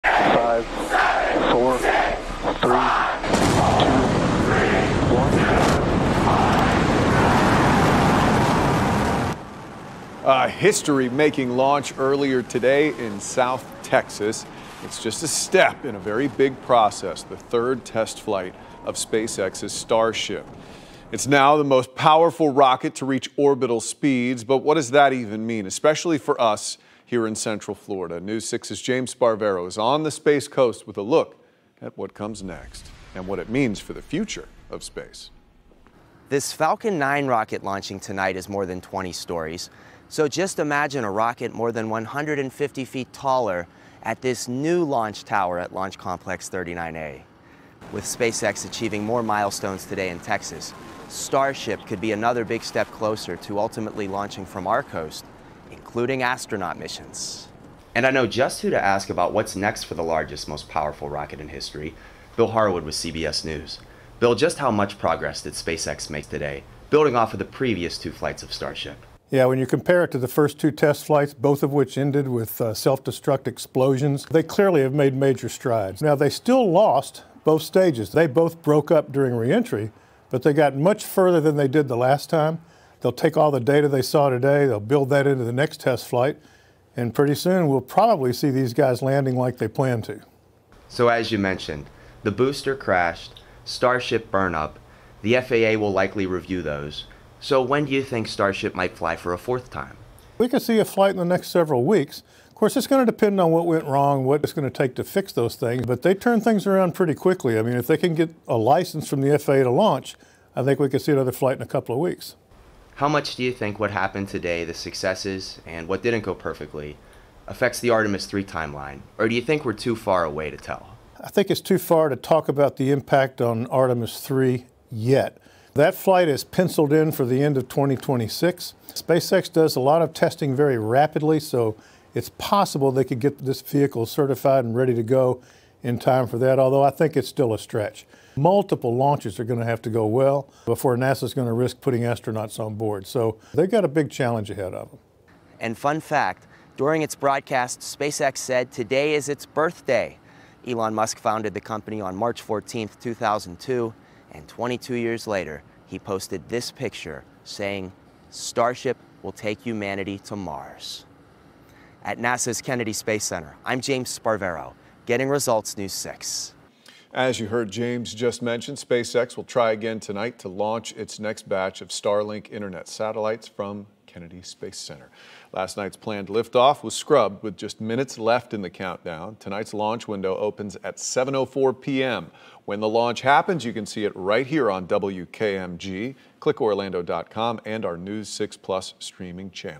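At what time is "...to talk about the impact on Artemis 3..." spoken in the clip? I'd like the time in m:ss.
2:02.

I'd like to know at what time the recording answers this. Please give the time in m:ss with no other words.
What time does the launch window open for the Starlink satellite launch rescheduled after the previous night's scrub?
3:00.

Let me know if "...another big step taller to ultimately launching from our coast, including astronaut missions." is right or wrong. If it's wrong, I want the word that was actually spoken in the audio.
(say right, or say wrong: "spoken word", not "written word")
wrong: "closer", not "taller".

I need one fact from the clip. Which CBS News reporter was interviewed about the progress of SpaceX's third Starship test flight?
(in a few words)
Bill Harwood.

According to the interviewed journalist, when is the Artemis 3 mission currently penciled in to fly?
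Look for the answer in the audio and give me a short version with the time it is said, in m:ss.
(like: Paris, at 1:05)
end of 2026, at 2:07.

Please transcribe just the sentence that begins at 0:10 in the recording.
A history-making launch earlier today in South Texas.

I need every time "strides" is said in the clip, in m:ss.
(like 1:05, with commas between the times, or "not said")
1:15.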